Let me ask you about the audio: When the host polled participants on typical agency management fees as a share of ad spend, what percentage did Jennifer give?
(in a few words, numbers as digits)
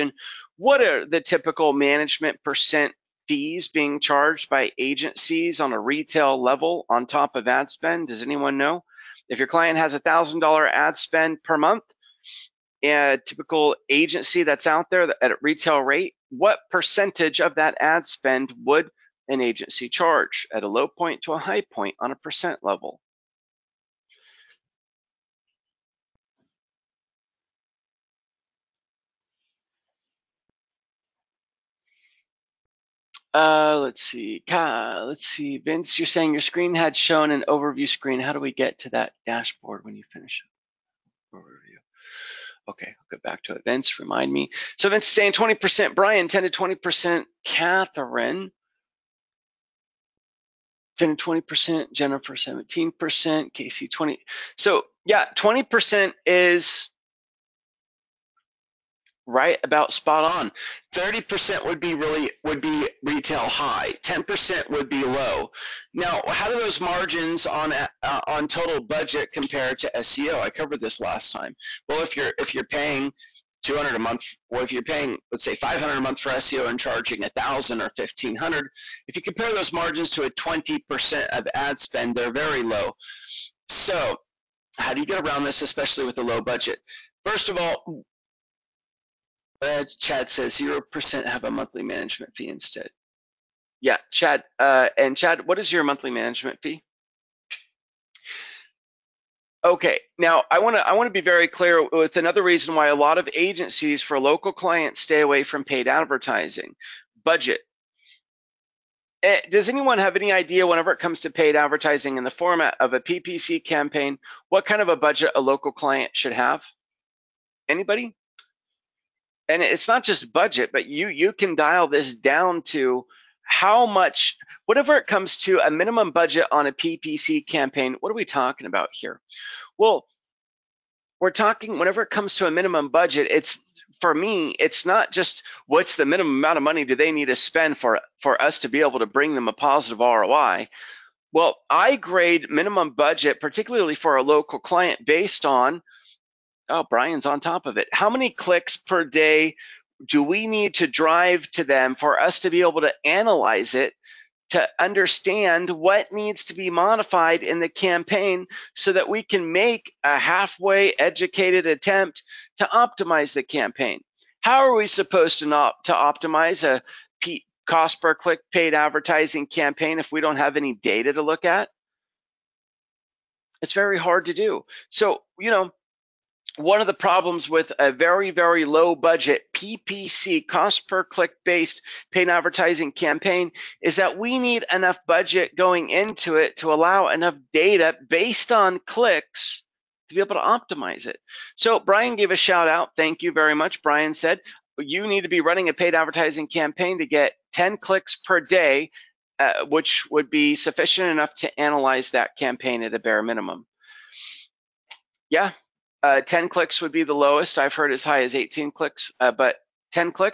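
17%.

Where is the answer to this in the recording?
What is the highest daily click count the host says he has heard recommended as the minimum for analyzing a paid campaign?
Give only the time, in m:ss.
3:28.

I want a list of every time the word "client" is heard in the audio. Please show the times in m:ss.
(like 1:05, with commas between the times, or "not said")
0:09, 1:44, 1:55, 2:24.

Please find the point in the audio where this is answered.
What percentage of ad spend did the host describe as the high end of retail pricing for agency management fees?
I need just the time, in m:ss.
1:00.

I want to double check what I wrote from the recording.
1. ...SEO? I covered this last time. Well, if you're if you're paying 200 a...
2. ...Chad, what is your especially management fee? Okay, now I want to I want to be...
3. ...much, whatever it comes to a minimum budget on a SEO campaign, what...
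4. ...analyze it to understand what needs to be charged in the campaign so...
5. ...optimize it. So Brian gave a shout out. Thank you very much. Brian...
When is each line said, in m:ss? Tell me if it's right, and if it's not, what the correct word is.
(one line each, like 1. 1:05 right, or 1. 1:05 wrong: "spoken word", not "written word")
1. 1:09 right
2. 1:35 wrong: "monthly", not "especially"
3. 2:03 wrong: "PPC", not "SEO"
4. 2:33 wrong: "modified", not "charged"
5. 3:10 right.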